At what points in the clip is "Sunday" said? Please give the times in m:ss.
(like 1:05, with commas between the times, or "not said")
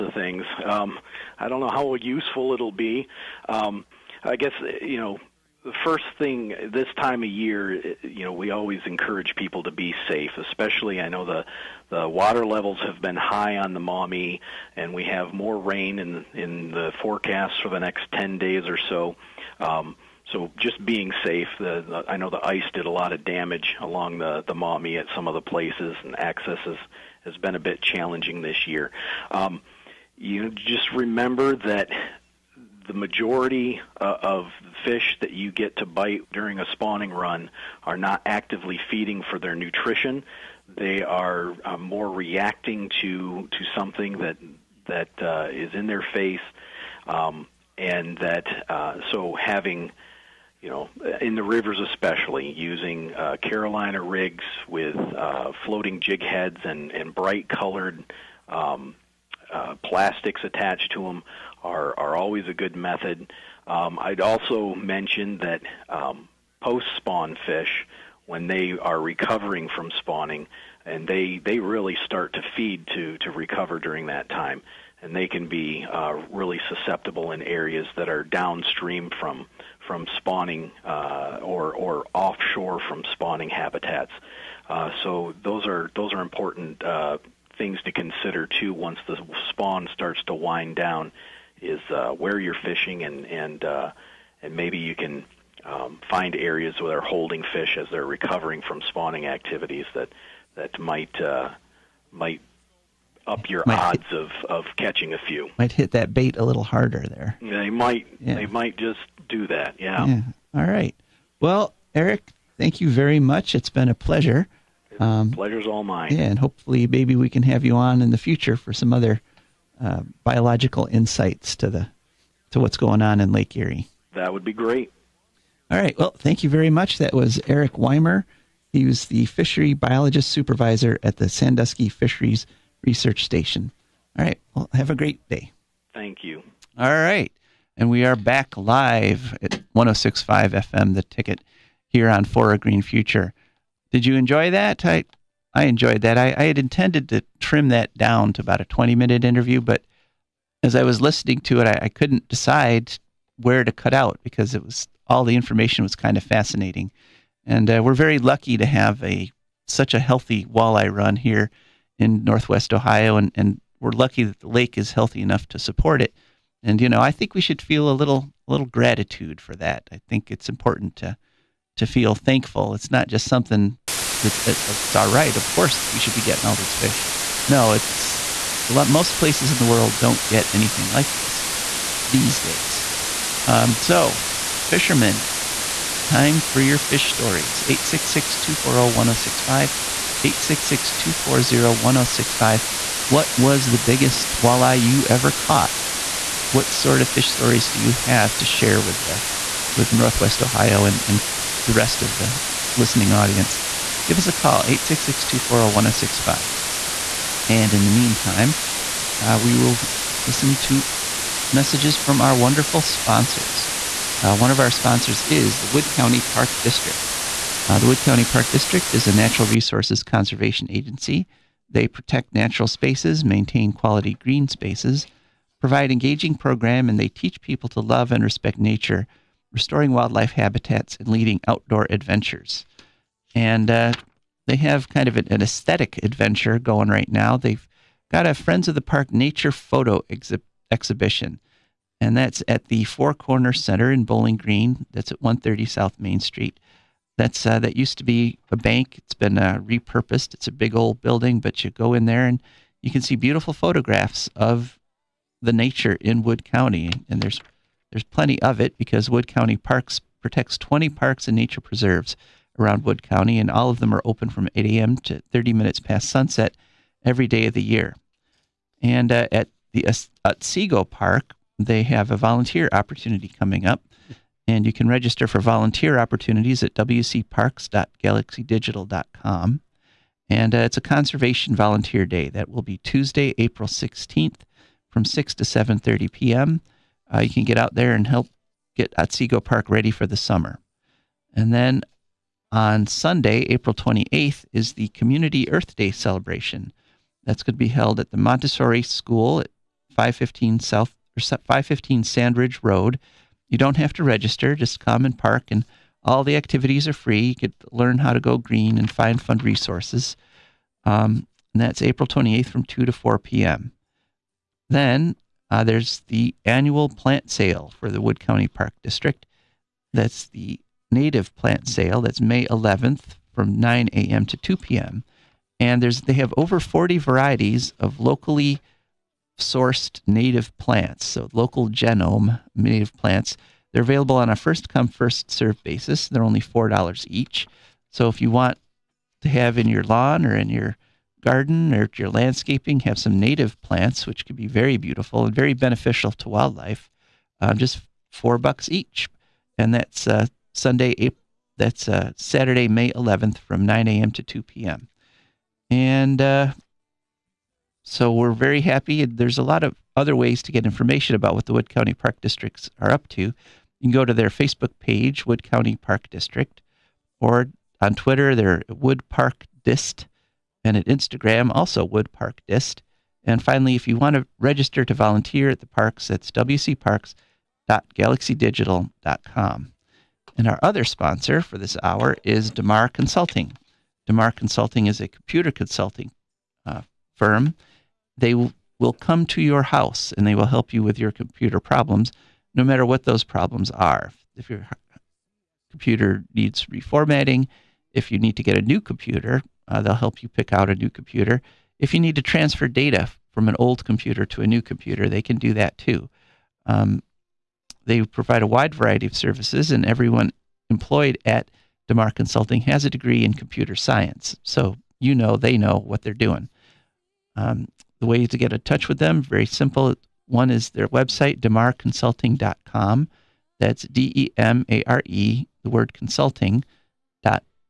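4:52, 5:50.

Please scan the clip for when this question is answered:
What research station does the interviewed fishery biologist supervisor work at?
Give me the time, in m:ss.
2:11.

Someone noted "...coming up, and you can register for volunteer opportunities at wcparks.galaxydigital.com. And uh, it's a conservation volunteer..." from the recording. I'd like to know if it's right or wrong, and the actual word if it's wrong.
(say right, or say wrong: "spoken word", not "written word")
right.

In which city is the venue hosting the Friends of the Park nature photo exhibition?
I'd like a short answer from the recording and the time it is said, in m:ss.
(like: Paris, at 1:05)
Bowling Green, at 4:04.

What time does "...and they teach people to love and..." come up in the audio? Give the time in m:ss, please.
3:46.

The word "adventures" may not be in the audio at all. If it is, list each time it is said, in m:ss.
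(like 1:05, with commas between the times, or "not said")
3:51, 3:55.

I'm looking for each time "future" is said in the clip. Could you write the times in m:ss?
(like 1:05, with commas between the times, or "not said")
1:58, 2:22.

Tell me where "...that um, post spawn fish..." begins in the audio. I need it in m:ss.
1:05.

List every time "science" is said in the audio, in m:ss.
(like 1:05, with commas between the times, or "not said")
6:53.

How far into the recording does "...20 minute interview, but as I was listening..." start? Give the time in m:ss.
2:28.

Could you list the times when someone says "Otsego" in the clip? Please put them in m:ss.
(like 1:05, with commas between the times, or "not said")
4:30, 4:48.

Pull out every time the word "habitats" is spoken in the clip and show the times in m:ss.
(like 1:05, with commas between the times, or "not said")
1:23, 3:50.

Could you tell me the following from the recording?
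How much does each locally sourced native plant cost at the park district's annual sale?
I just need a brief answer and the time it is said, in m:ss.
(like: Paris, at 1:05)
$4, at 5:36.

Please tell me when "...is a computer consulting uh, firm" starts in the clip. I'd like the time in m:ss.
6:24.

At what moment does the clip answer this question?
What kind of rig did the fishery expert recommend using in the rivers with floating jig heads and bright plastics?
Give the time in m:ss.
0:53.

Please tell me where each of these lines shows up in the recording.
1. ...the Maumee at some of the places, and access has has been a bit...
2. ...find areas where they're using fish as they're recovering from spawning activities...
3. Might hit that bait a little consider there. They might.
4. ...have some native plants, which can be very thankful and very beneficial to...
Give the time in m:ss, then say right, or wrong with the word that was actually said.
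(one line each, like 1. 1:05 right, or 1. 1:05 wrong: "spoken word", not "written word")
1. 0:24 right
2. 1:36 wrong: "holding", not "using"
3. 1:45 wrong: "harder", not "consider"
4. 5:42 wrong: "beautiful", not "thankful".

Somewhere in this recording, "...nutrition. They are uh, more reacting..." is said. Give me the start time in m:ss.
0:39.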